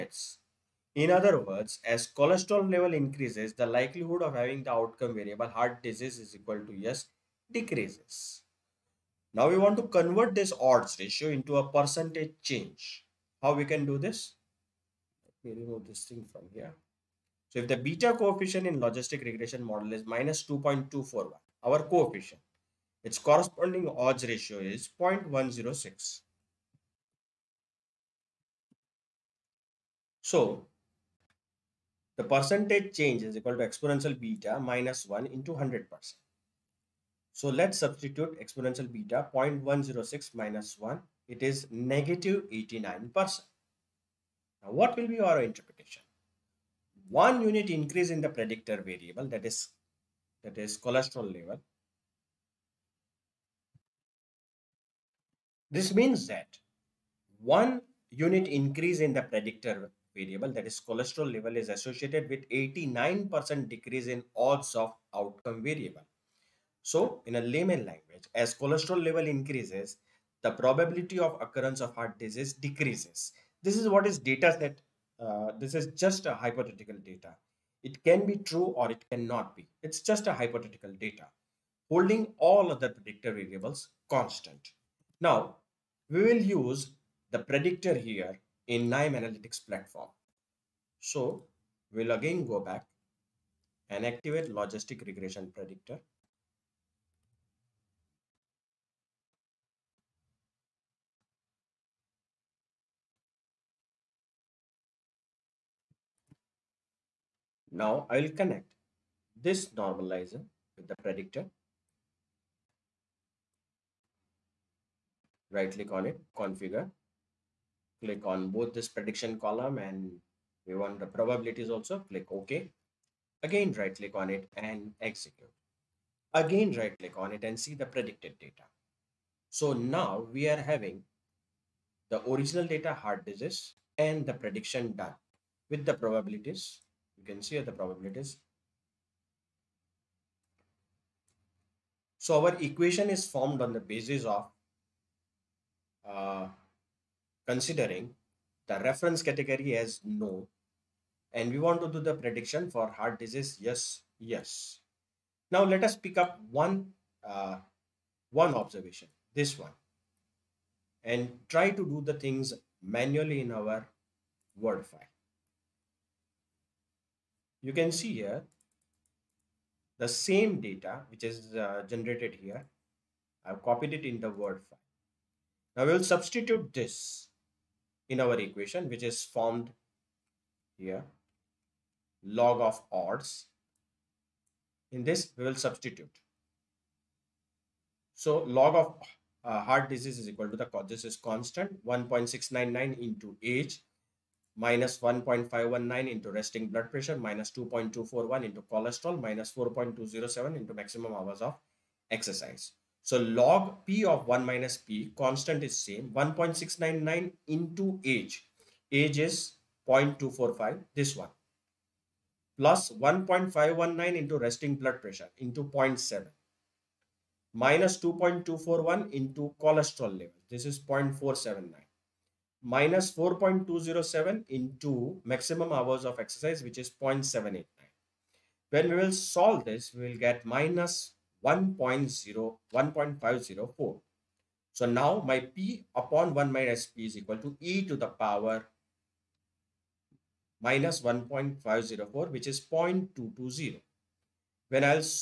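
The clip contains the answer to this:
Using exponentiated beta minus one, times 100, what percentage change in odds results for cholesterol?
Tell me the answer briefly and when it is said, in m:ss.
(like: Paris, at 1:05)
-89%, at 0:41.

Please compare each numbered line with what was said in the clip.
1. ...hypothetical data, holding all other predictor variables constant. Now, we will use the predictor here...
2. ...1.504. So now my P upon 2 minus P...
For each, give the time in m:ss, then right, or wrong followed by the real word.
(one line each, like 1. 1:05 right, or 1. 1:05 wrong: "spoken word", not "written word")
1. 1:20 right
2. 3:52 wrong: "1", not "2".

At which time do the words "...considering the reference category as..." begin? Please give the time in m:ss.
2:27.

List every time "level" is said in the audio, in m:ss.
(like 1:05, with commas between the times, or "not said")
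0:02, 0:51, 1:01, 1:09, 3:40.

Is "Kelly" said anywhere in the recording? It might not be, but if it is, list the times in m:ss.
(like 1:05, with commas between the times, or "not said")
not said.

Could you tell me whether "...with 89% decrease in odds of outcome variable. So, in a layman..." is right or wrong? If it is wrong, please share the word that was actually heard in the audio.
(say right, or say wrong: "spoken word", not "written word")
right.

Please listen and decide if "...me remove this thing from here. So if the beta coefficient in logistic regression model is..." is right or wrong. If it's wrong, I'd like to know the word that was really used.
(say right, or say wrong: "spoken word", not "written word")
right.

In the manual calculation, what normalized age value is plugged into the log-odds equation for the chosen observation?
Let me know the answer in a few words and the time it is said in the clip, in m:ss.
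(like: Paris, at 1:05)
0.245, at 3:29.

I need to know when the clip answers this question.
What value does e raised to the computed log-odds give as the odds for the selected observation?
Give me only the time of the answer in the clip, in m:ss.
4:02.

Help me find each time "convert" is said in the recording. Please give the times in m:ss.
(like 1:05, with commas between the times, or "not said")
0:09.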